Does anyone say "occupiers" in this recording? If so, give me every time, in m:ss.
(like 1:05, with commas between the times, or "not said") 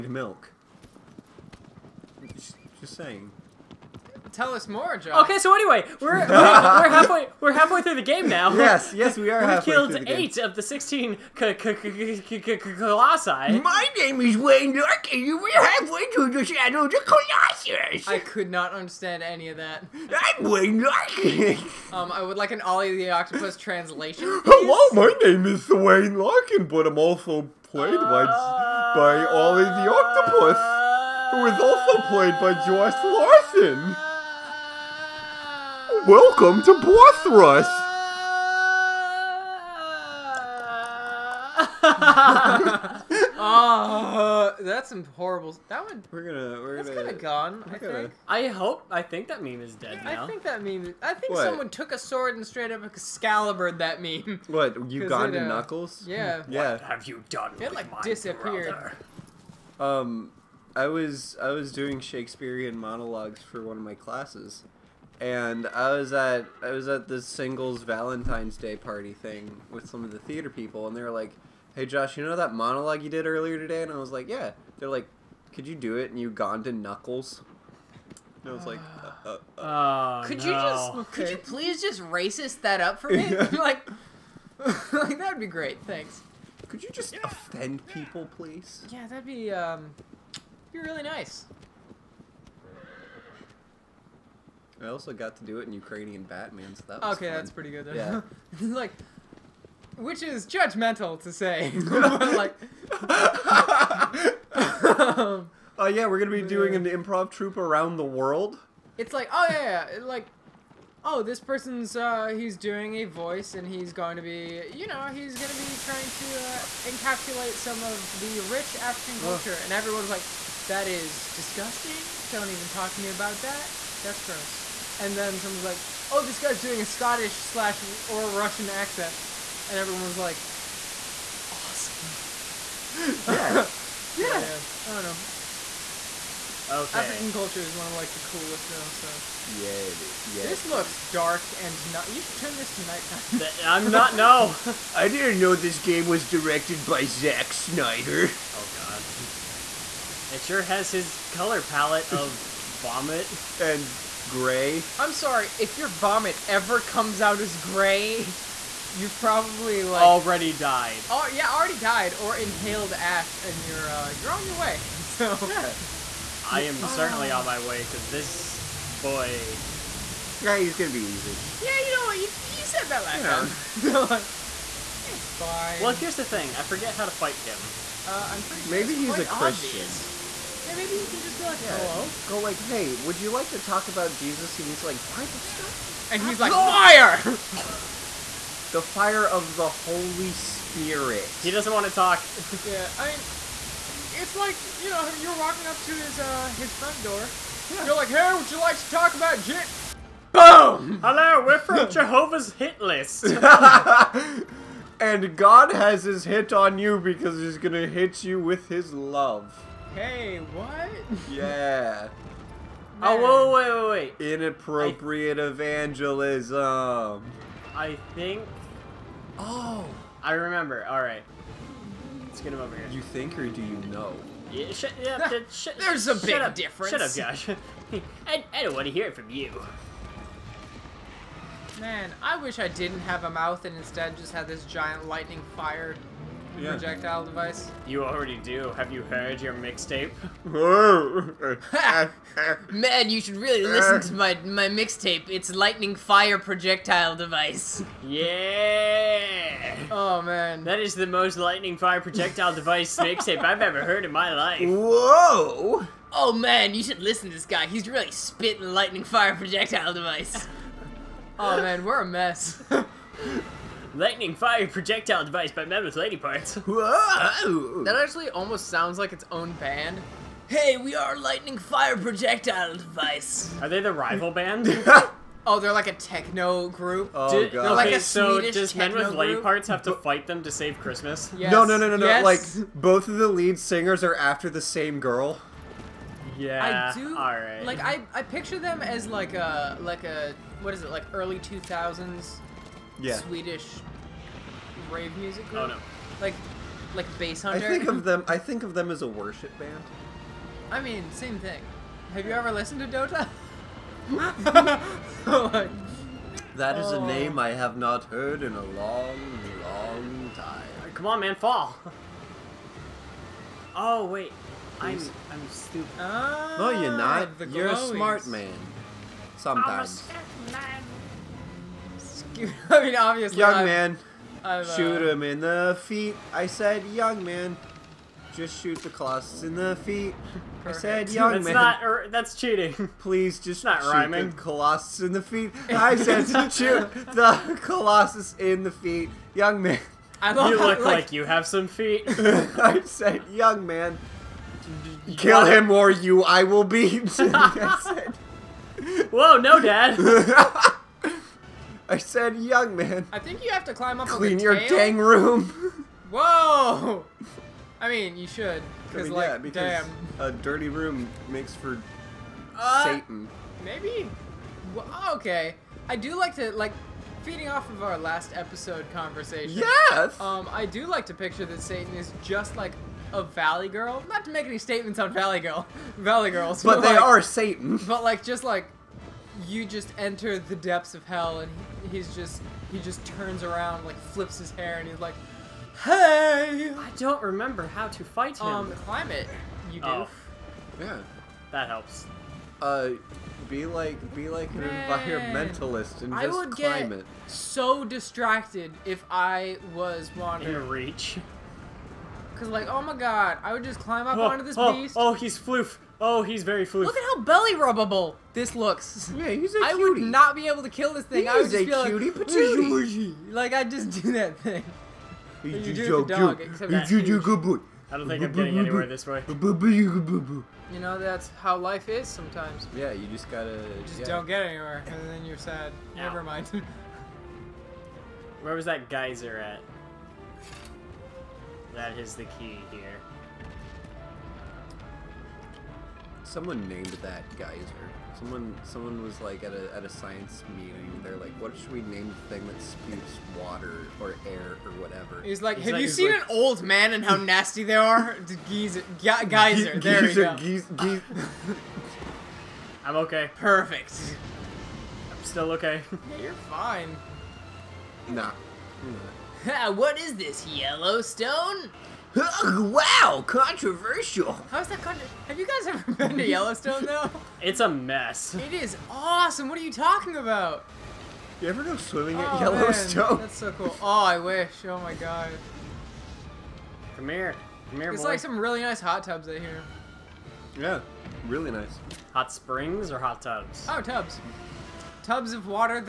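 not said.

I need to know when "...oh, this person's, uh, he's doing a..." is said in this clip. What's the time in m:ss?
1:51.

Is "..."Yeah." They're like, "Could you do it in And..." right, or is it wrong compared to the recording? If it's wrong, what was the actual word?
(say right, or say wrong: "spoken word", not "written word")
wrong: "Ugandan", not "And".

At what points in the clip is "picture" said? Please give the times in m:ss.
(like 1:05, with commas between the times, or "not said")
4:48, 6:11.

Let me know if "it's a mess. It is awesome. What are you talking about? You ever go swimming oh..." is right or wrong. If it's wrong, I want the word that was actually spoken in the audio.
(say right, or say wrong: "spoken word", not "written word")
right.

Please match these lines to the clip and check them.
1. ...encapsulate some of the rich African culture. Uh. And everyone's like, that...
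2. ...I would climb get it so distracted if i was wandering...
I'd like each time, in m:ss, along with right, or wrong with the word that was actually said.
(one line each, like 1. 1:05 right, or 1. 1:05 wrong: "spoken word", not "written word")
1. 1:56 right
2. 6:36 right.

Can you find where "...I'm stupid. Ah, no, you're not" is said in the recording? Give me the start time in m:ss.
5:15.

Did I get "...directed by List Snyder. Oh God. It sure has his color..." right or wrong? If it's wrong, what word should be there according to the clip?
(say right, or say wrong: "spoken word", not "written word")
wrong: "Zack", not "List".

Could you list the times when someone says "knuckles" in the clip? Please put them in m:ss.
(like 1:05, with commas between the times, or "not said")
0:55, 1:16.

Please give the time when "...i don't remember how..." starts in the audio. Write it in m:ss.
6:26.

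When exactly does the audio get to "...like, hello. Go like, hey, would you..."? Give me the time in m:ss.
3:01.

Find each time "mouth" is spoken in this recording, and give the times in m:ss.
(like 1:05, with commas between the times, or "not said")
3:53.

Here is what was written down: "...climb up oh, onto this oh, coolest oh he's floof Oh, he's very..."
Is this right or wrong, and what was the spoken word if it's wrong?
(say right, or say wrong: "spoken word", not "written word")
wrong: "beast", not "coolest".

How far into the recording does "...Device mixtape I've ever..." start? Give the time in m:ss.
4:12.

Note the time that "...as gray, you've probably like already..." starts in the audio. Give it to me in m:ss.
2:37.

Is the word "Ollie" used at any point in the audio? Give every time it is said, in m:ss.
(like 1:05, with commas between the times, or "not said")
0:22, 0:29.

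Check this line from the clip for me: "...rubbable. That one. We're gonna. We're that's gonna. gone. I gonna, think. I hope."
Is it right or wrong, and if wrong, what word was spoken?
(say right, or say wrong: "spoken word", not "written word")
wrong: "horrible", not "rubbable".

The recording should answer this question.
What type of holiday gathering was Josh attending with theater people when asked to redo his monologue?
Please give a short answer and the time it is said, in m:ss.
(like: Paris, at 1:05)
singles Valentine's Day party, at 1:07.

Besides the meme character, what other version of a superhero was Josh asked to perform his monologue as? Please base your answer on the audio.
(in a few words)
Ukrainian Batman.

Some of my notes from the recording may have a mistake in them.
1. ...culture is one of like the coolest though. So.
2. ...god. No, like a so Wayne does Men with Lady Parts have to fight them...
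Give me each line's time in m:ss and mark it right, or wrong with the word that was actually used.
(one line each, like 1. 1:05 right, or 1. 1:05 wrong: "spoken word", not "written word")
1. 2:17 right
2. 4:37 wrong: "Swedish", not "Wayne".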